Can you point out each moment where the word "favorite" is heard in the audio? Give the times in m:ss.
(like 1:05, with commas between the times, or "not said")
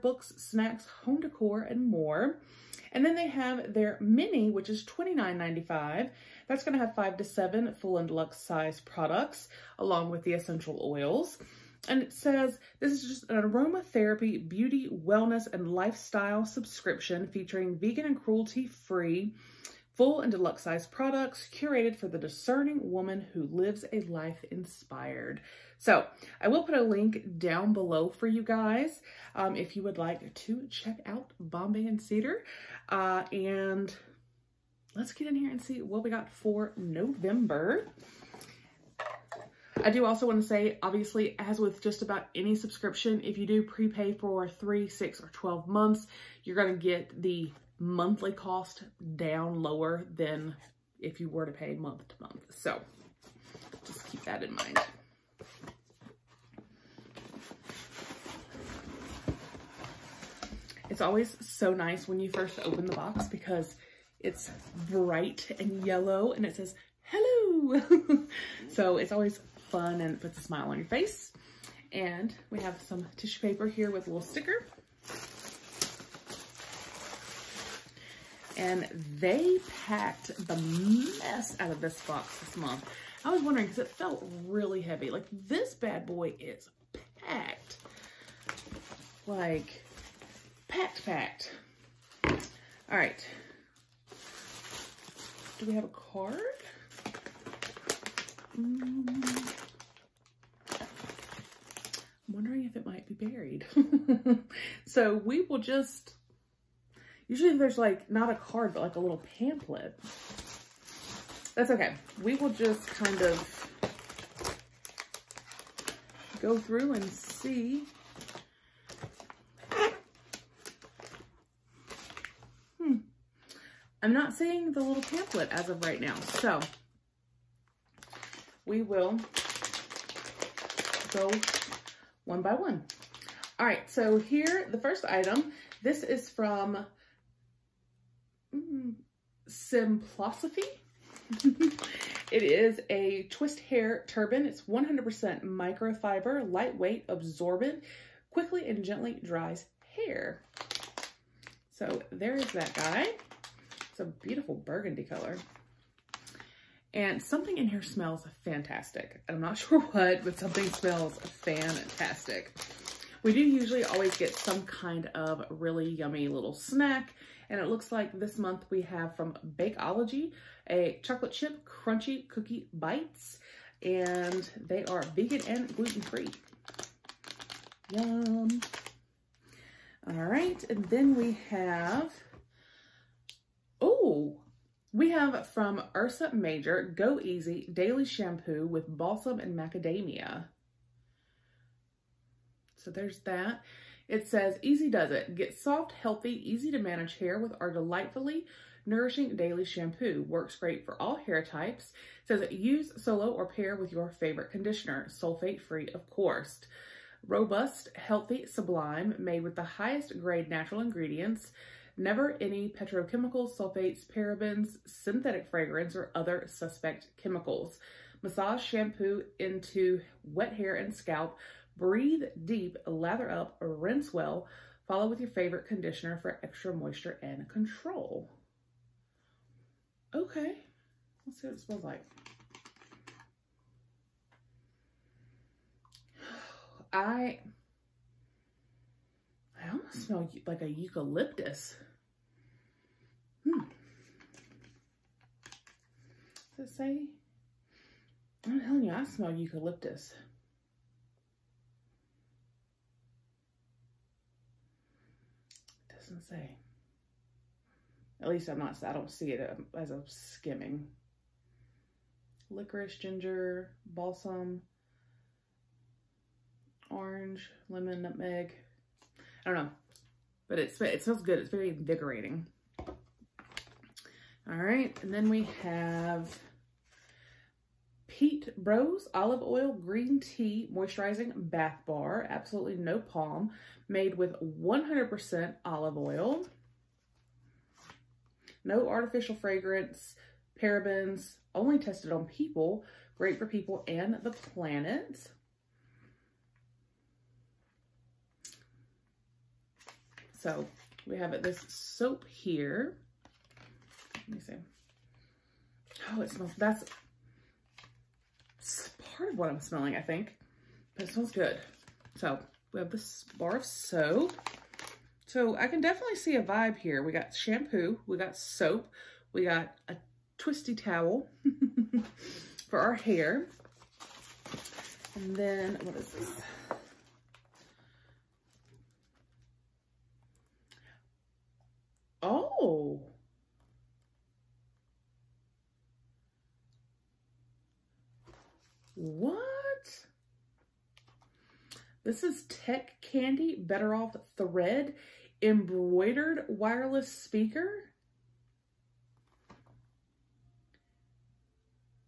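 3:24, 3:45.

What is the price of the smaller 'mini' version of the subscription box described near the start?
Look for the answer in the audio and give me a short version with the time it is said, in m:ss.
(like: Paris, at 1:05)
$29.95, at 0:04.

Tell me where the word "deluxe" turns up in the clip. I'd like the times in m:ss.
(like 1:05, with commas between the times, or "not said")
0:08, 0:20.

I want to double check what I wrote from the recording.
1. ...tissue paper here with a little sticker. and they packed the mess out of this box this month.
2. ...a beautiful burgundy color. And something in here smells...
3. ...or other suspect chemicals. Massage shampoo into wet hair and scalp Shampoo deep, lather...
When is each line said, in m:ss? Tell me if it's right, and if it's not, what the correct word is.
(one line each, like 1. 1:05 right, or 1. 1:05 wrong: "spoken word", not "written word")
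1. 1:13 right
2. 2:33 right
3. 3:35 wrong: "Breathe", not "Shampoo".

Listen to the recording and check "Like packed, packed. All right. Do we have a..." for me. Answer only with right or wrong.
right.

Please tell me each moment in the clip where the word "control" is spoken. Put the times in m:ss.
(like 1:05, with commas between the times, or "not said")
3:47.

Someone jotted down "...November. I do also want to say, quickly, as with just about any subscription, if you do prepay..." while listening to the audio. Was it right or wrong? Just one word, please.
wrong.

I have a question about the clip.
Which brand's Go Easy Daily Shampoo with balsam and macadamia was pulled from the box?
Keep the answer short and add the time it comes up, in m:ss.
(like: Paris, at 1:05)
Ursa Major, at 3:05.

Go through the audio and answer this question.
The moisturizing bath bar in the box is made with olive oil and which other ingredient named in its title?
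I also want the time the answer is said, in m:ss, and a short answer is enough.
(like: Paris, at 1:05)
Green tea, at 4:39.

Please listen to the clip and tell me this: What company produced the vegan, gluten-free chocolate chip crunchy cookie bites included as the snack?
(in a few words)
Bakeology.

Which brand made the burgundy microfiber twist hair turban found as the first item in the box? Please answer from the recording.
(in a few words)
Simplosophy.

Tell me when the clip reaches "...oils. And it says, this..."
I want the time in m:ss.
0:10.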